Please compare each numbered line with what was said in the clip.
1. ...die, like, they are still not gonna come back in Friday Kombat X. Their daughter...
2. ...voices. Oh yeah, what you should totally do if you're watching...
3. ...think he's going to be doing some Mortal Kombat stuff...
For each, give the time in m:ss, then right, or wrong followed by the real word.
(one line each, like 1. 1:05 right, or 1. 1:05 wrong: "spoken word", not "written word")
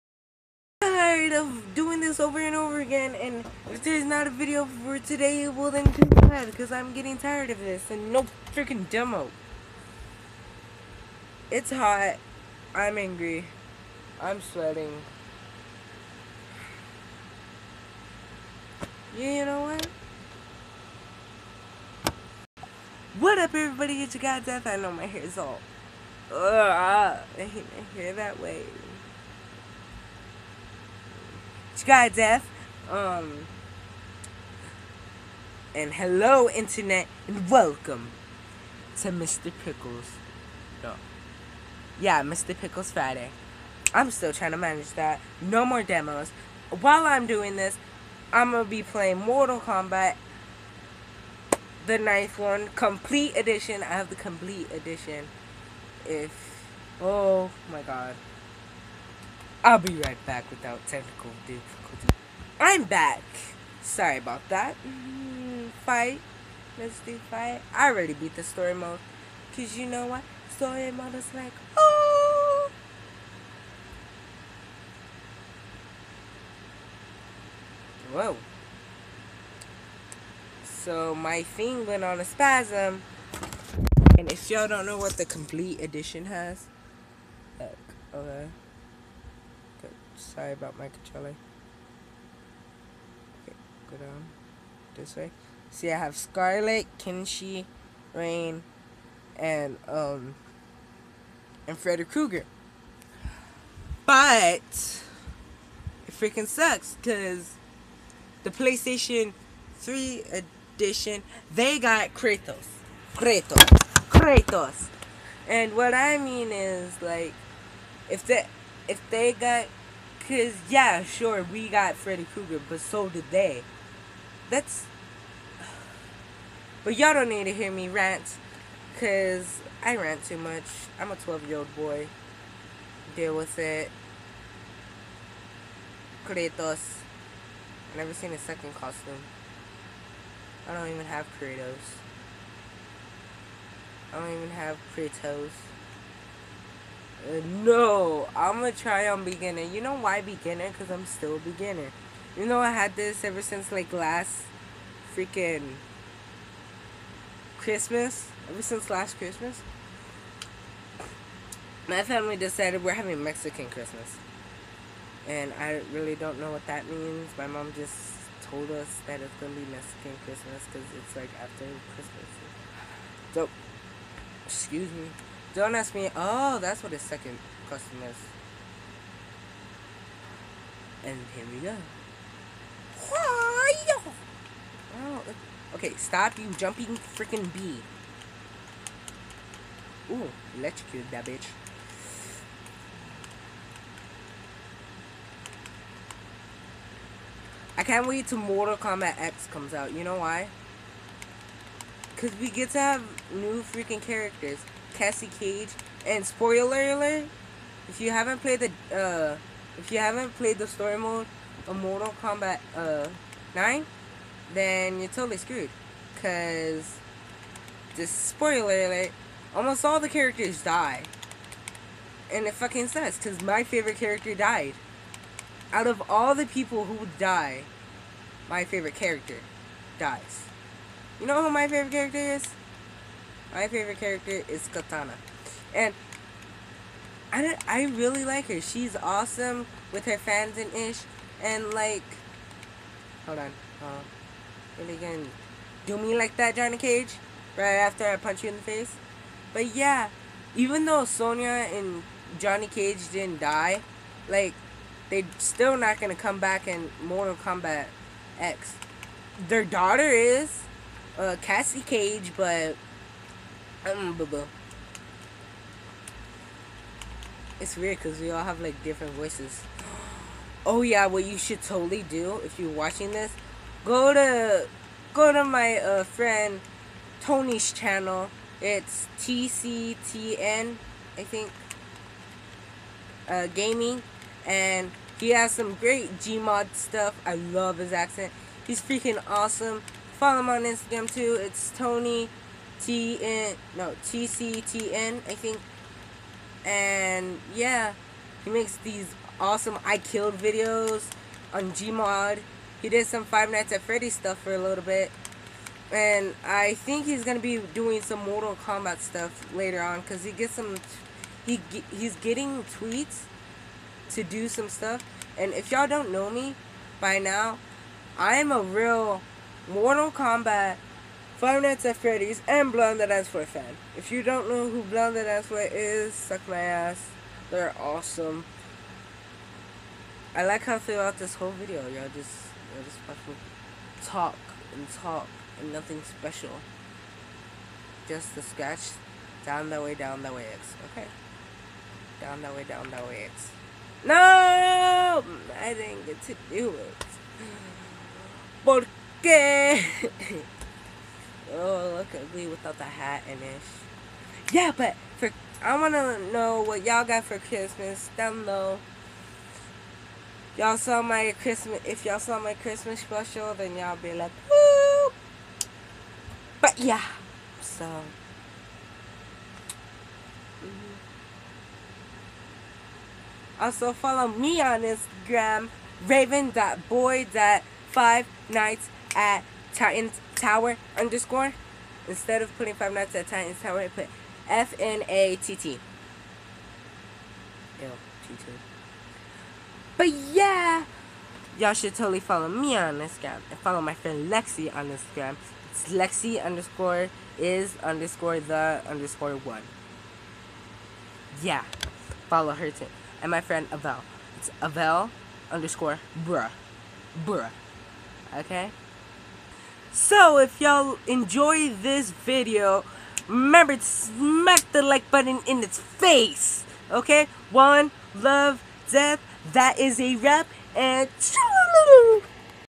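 1. 4:13 wrong: "Mortal", not "Friday"
2. 4:29 right
3. 5:06 right.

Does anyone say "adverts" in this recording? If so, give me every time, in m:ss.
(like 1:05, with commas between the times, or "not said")
not said.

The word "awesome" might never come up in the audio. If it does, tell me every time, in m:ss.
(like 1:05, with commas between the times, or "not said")
3:58, 4:49, 4:59, 5:27.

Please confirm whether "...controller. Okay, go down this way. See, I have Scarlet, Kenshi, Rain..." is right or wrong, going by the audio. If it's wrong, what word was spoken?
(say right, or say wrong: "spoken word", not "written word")
right.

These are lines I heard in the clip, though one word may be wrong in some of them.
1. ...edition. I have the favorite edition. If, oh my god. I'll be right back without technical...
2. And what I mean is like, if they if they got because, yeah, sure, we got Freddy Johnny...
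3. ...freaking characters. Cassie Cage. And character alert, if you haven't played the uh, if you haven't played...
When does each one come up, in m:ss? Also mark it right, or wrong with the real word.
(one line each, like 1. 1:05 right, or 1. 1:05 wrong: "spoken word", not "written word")
1. 0:53 wrong: "complete", not "favorite"
2. 1:55 wrong: "Krueger", not "Johnny"
3. 3:23 wrong: "spoiler", not "character".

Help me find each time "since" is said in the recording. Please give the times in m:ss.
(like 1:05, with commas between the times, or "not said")
2:33, 2:38.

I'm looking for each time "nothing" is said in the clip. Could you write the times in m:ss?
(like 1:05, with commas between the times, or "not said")
5:35.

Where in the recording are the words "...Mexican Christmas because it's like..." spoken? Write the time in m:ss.
2:49.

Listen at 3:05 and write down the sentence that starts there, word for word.
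Oh, okay, stop you jumping freaking bee.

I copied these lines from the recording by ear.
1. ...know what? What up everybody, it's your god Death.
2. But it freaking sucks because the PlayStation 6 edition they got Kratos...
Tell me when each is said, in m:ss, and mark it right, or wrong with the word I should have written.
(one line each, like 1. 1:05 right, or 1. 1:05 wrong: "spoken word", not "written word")
1. 0:19 right
2. 1:44 wrong: "3", not "6".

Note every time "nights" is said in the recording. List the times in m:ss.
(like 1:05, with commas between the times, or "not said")
5:03, 5:21, 6:18, 6:22.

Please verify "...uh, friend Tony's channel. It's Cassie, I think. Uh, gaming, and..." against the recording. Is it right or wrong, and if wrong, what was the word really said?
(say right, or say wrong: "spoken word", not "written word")
wrong: "TCTN", not "Cassie".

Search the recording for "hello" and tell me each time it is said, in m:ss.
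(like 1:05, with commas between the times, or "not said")
0:35.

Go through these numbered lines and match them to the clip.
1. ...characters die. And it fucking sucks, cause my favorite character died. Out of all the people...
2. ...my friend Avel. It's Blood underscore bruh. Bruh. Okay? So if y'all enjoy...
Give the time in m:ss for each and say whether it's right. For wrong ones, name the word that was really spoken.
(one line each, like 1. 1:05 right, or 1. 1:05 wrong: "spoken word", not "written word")
1. 3:40 right
2. 6:43 wrong: "Avel", not "Blood".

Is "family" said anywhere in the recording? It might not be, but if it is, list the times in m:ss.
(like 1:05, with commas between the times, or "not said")
2:42.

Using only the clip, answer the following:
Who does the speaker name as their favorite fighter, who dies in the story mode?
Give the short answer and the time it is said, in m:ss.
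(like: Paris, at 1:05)
Katana, at 3:54.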